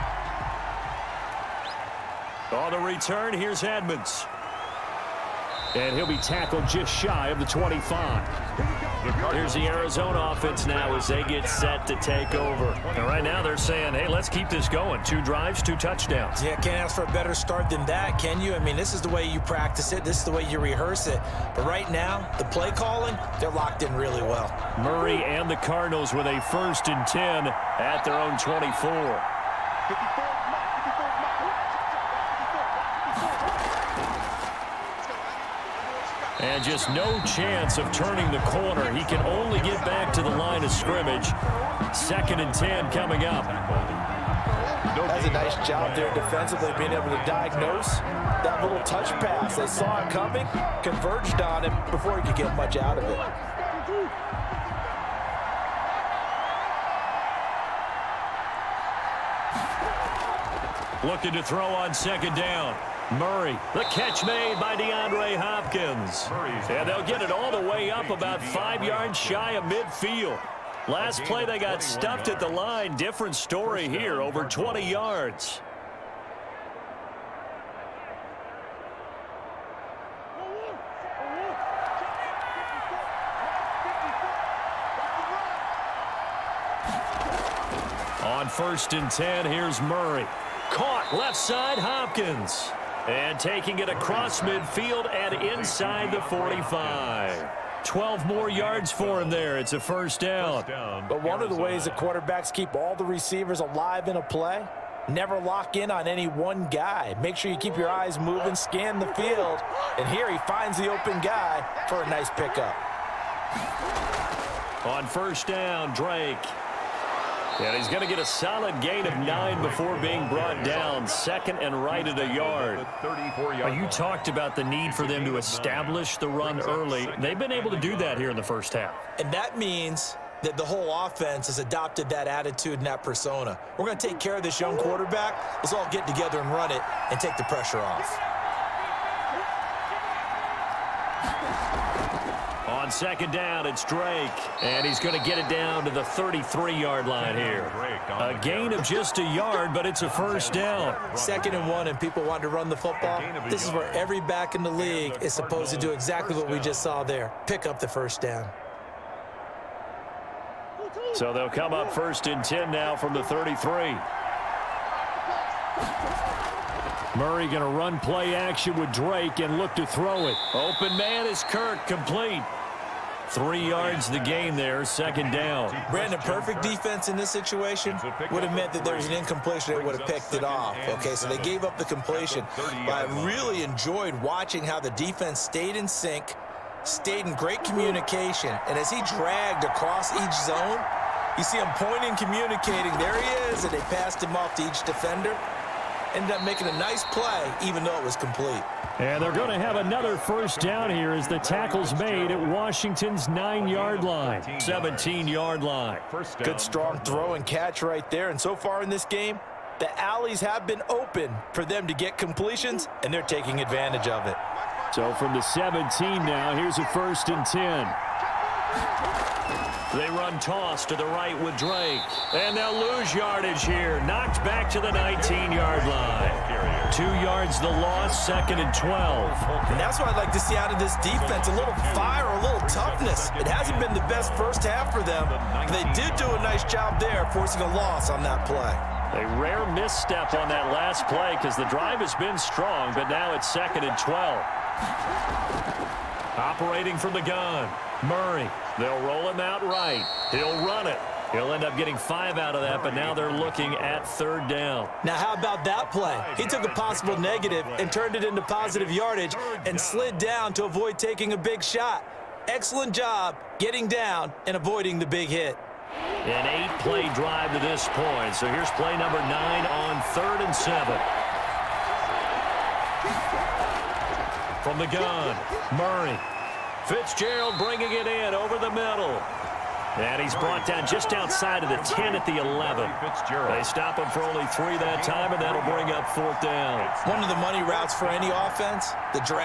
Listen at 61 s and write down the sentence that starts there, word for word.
Looking to throw on second down.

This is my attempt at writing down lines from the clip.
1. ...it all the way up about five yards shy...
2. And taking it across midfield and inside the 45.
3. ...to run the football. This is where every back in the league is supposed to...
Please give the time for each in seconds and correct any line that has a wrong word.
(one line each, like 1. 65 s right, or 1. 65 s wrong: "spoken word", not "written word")
1. 67 s right
2. 93 s right
3. 152 s right.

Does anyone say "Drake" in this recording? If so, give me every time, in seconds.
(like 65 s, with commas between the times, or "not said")
115 s, 143 s, 168 s, 221 s.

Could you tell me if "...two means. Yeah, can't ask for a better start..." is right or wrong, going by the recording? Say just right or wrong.
wrong.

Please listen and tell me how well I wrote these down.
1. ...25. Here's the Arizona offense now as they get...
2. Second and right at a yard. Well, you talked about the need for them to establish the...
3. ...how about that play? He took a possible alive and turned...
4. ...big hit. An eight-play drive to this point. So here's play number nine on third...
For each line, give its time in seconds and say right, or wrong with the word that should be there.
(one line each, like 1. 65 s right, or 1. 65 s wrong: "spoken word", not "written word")
1. 7 s right
2. 121 s right
3. 255 s wrong: "negative", not "alive"
4. 265 s right.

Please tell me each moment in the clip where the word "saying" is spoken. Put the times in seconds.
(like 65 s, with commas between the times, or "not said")
13 s.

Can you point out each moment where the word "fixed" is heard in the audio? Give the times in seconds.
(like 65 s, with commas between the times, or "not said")
not said.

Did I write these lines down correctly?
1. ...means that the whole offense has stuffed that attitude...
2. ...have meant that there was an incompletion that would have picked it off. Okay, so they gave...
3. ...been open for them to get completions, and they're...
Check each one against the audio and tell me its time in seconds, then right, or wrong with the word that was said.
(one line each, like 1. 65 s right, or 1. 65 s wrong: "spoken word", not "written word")
1. 129 s wrong: "adopted", not "stuffed"
2. 178 s right
3. 210 s right.